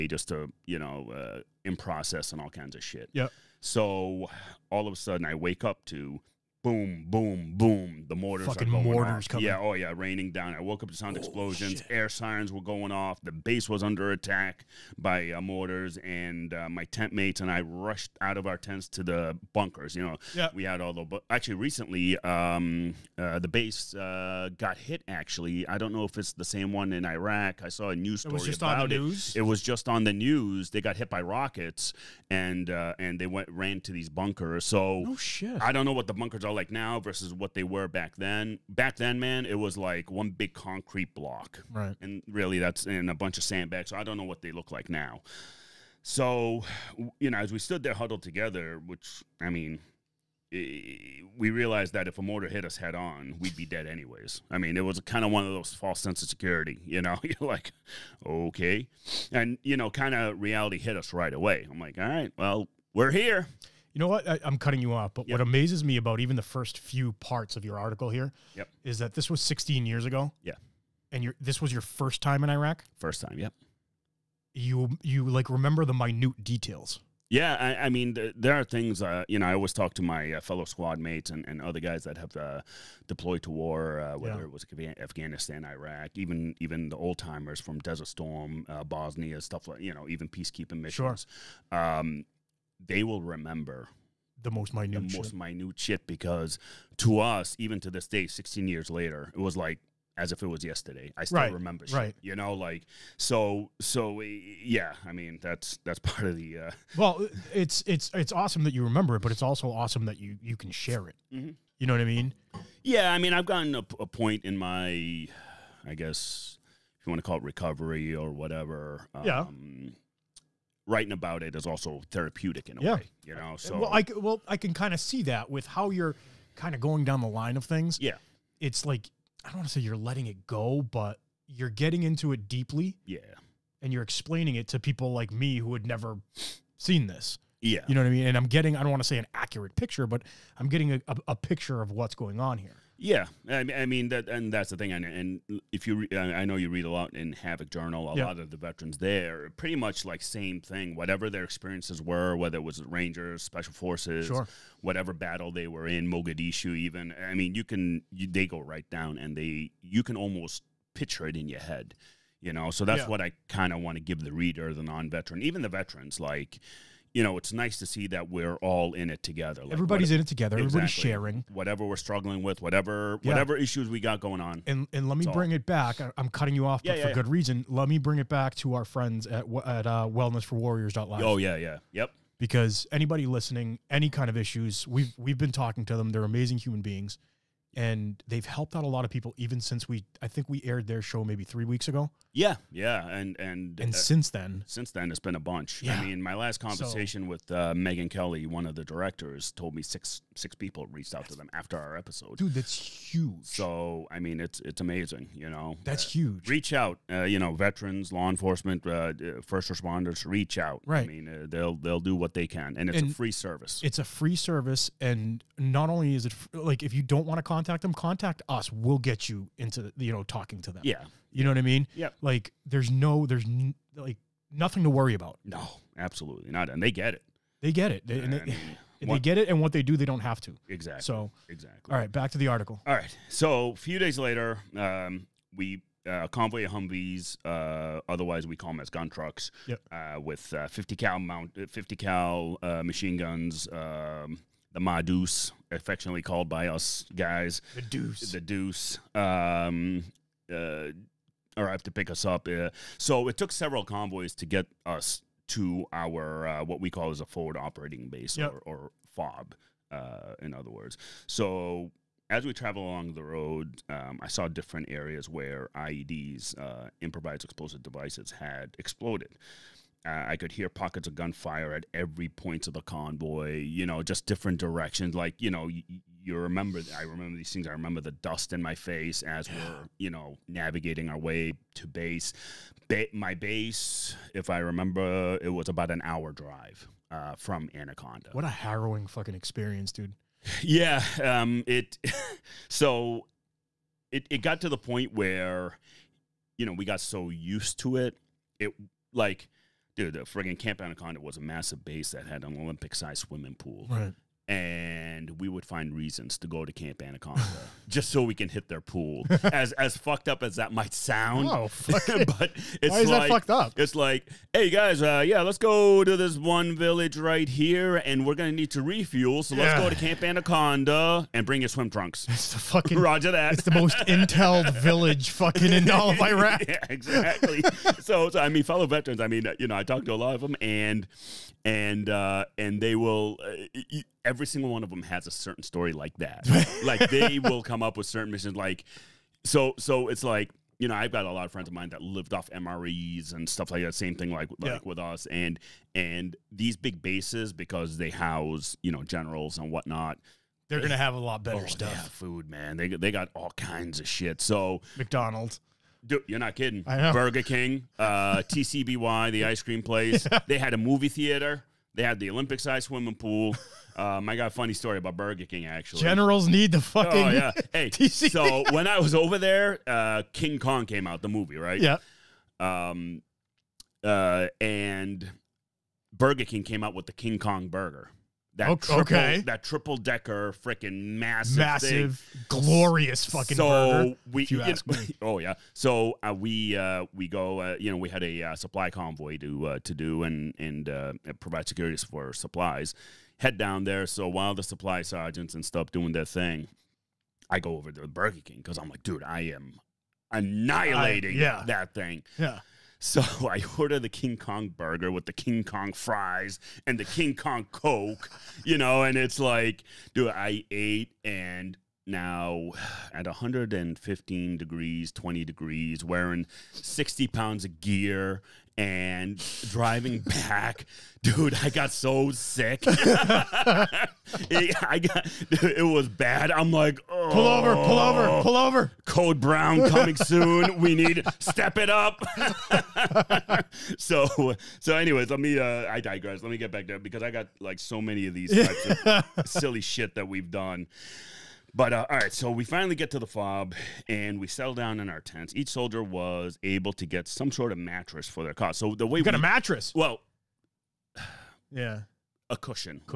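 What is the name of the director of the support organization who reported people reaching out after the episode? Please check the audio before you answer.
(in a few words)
Megan Kelly.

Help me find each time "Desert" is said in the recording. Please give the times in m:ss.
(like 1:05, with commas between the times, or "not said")
1:27.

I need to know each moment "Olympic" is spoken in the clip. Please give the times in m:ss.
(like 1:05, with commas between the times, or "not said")
5:02, 6:02.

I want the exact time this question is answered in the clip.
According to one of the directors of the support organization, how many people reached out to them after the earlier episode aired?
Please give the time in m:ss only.
3:19.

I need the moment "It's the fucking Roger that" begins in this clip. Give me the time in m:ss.
5:22.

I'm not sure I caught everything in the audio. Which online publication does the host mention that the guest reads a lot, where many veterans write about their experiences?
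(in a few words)
Havok Journal.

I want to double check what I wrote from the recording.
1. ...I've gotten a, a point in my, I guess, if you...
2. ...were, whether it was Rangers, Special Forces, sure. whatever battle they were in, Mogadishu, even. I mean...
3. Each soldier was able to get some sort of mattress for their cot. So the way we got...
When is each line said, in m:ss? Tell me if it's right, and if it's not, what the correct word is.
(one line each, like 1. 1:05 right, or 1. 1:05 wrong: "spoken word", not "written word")
1. 1:53 right
2. 2:32 right
3. 7:25 right.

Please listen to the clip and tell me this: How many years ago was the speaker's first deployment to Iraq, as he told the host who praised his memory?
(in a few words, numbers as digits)
16.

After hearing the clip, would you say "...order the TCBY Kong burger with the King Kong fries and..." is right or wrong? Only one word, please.
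wrong.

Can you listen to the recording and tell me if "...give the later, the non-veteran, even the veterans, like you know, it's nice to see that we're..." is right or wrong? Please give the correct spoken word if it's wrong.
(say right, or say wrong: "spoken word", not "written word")
wrong: "reader", not "later".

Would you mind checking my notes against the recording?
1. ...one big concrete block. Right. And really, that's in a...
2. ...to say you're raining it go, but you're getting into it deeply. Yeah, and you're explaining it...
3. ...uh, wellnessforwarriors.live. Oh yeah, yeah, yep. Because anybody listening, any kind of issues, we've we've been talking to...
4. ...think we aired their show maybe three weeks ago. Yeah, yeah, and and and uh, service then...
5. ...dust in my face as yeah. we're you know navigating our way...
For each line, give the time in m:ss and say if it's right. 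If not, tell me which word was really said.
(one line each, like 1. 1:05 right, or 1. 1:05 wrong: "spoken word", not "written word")
1. 0:40 right
2. 2:09 wrong: "letting", not "raining"
3. 2:59 right
4. 3:10 wrong: "since", not "service"
5. 4:38 right.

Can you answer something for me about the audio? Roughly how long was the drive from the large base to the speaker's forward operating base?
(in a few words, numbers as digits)
about an hour.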